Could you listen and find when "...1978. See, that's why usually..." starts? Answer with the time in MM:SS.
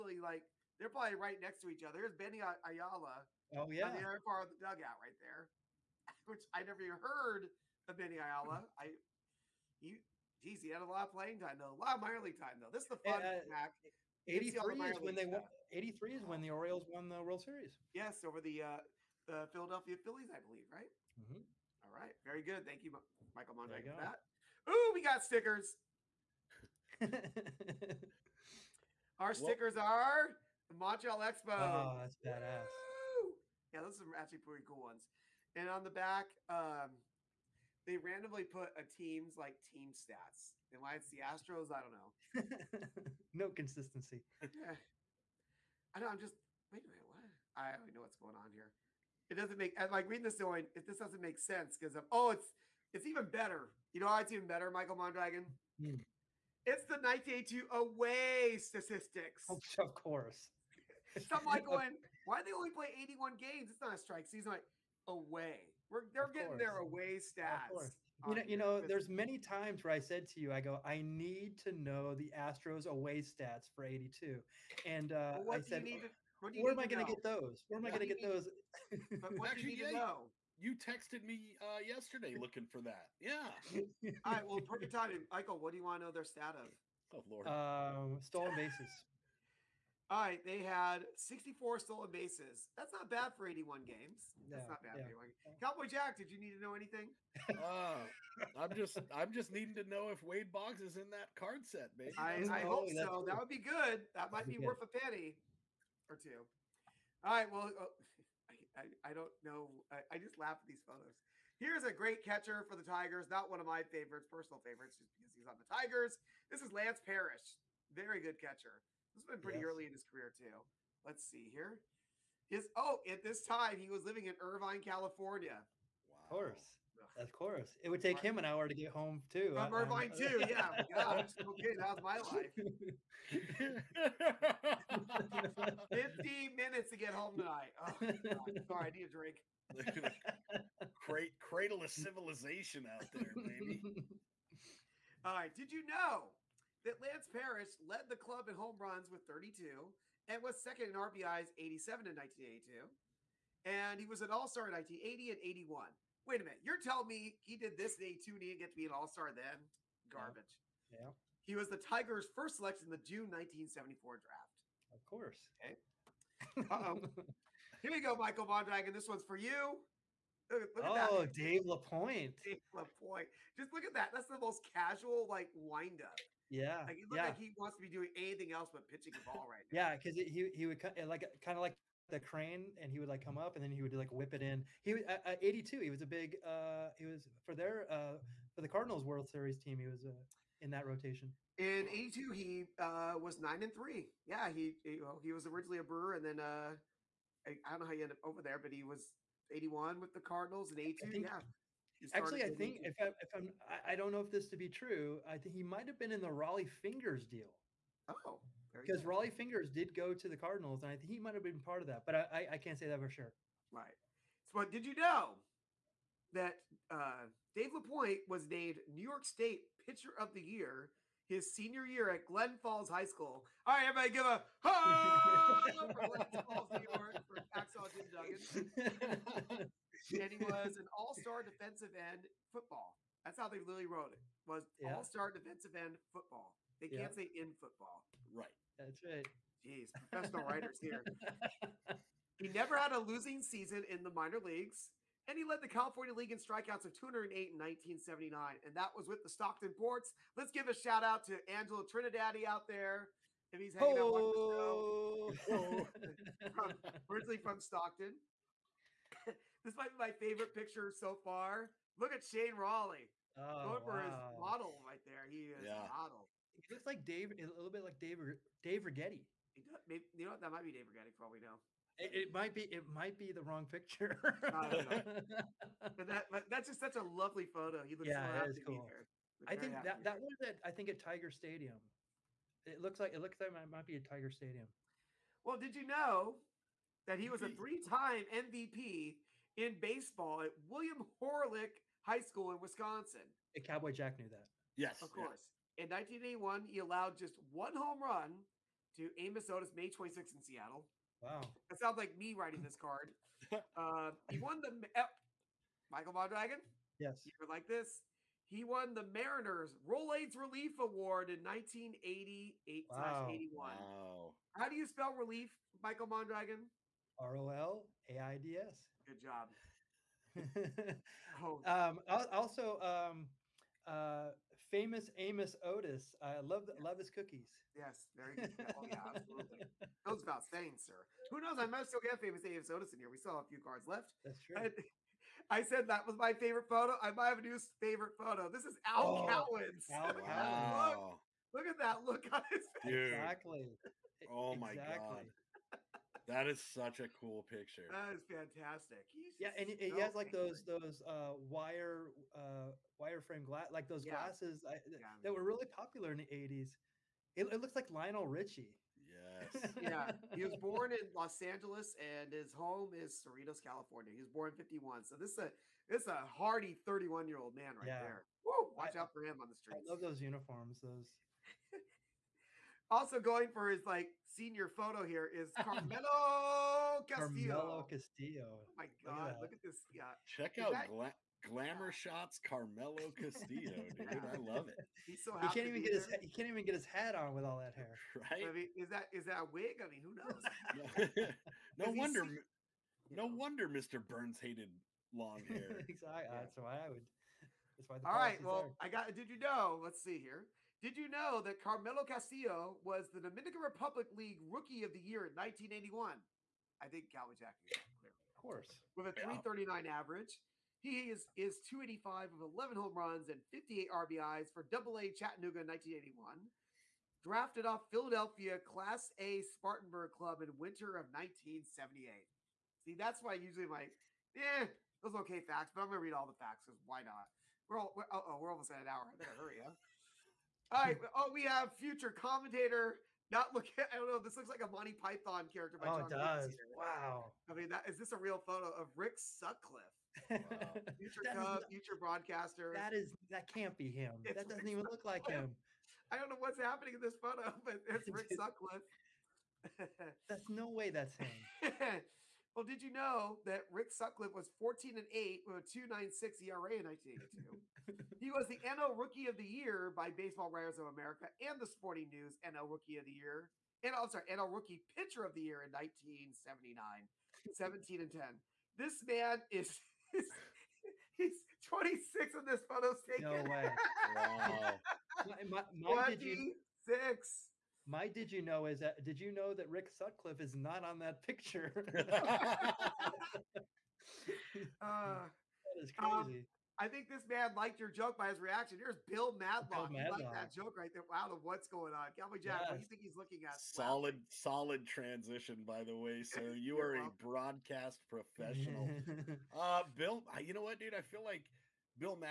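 07:01.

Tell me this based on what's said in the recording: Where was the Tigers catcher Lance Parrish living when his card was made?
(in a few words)
Irvine, California.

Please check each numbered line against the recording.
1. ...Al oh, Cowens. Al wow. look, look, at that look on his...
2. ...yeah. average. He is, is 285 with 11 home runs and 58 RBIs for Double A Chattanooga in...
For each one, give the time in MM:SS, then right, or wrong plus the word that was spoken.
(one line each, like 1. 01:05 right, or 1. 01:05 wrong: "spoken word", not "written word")
1. 05:38 right
2. 06:49 right.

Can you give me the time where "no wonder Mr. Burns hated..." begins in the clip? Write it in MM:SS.
06:33.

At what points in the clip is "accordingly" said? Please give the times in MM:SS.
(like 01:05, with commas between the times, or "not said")
not said.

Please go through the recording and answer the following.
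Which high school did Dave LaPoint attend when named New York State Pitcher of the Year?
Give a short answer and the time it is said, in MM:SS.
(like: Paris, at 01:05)
Glen Falls High School, at 03:42.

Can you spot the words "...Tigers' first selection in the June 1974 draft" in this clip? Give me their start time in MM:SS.
02:41.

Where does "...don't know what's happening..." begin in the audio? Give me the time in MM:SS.
07:26.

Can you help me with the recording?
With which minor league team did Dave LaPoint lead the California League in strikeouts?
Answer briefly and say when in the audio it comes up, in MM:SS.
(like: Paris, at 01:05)
Stockton Ports, at 04:09.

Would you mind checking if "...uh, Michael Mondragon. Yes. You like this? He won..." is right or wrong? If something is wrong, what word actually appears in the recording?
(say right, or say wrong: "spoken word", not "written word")
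right.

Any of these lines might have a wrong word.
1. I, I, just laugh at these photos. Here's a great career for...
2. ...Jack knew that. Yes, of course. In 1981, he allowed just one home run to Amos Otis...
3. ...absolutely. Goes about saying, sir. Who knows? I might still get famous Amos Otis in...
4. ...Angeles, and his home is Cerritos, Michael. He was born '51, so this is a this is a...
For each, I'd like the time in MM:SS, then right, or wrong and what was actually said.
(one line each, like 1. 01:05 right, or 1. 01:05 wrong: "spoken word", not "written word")
1. 01:49 wrong: "catcher", not "career"
2. 04:53 right
3. 05:29 right
4. 06:01 wrong: "California", not "Michael".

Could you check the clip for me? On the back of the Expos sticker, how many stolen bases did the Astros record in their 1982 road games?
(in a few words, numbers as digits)
64.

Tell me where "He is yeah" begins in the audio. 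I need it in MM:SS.
04:25.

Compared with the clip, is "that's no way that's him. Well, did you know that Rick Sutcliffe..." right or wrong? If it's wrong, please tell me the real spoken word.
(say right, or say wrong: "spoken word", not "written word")
right.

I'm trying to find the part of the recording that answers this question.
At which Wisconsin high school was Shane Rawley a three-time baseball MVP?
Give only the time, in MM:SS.
04:50.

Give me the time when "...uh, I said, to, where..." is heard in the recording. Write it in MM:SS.
01:15.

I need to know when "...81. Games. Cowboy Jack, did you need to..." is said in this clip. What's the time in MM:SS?
01:35.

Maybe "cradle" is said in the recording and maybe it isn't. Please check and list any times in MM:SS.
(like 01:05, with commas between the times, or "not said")
02:21.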